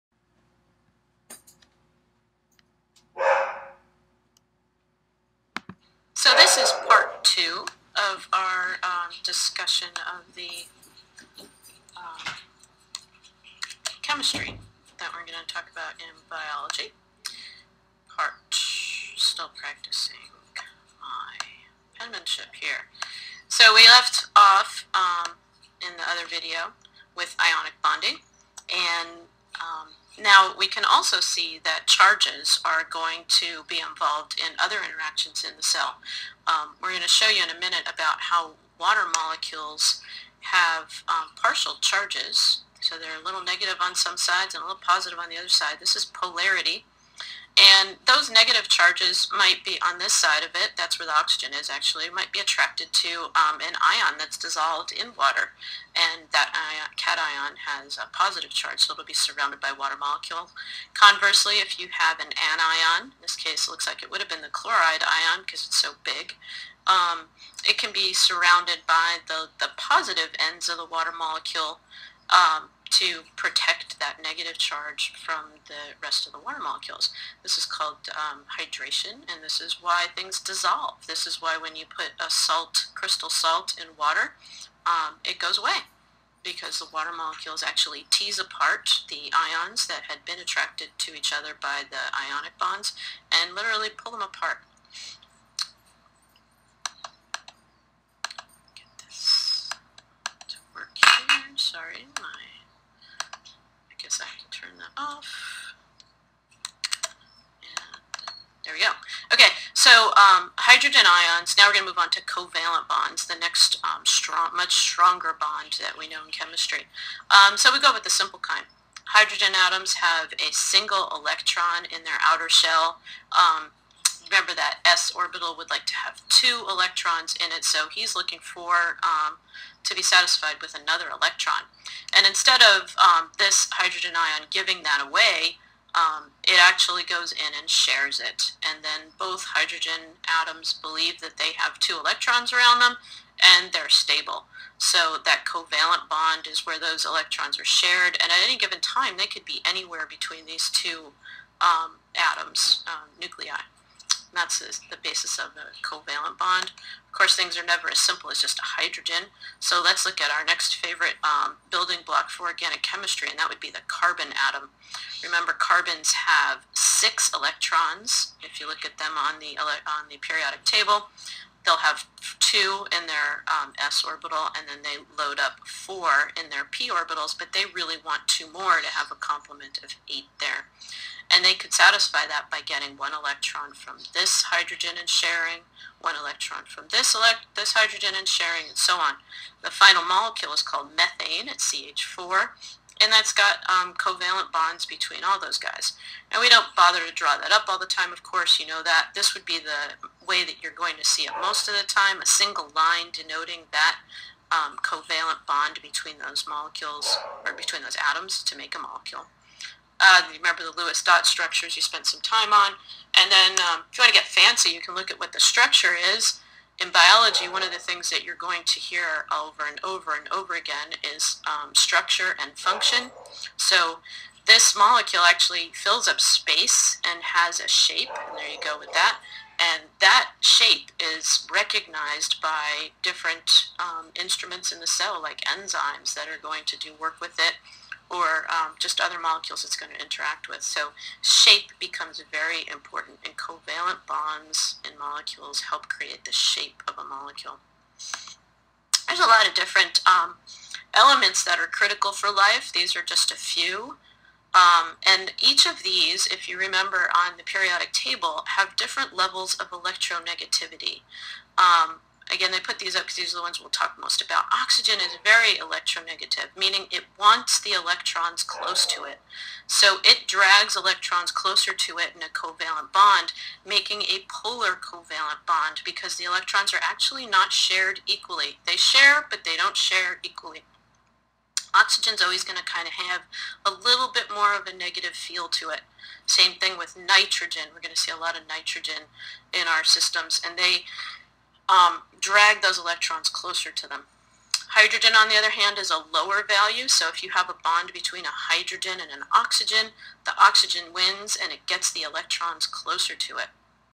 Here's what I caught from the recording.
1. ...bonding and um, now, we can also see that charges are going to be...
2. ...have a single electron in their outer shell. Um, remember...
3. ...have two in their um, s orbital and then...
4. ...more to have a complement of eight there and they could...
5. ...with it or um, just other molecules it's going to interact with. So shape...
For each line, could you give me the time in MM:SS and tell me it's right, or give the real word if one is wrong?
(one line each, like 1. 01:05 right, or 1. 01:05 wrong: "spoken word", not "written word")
1. 00:27 right
2. 01:59 right
3. 02:51 right
4. 02:58 right
5. 03:57 right.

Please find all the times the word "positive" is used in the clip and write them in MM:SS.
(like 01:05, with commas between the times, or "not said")
00:44, 00:58, 01:09.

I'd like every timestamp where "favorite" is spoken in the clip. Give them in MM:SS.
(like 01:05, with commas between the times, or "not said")
02:40.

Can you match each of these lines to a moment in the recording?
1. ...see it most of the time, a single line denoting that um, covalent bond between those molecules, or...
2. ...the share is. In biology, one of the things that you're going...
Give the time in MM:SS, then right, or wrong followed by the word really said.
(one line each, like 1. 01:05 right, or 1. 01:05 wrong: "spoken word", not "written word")
1. 03:21 right
2. 03:35 wrong: "structure", not "share".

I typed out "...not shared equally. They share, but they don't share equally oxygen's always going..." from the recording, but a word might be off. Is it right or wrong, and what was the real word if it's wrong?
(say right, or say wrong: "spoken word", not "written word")
right.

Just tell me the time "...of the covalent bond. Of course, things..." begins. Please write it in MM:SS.
02:35.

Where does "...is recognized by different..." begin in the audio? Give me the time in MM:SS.
03:50.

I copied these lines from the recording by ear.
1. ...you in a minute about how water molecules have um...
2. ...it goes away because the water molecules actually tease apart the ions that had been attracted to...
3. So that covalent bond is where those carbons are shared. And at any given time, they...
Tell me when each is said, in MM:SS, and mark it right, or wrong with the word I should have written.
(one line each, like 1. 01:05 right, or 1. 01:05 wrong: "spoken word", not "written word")
1. 00:37 right
2. 01:25 right
3. 02:24 wrong: "electrons", not "carbons".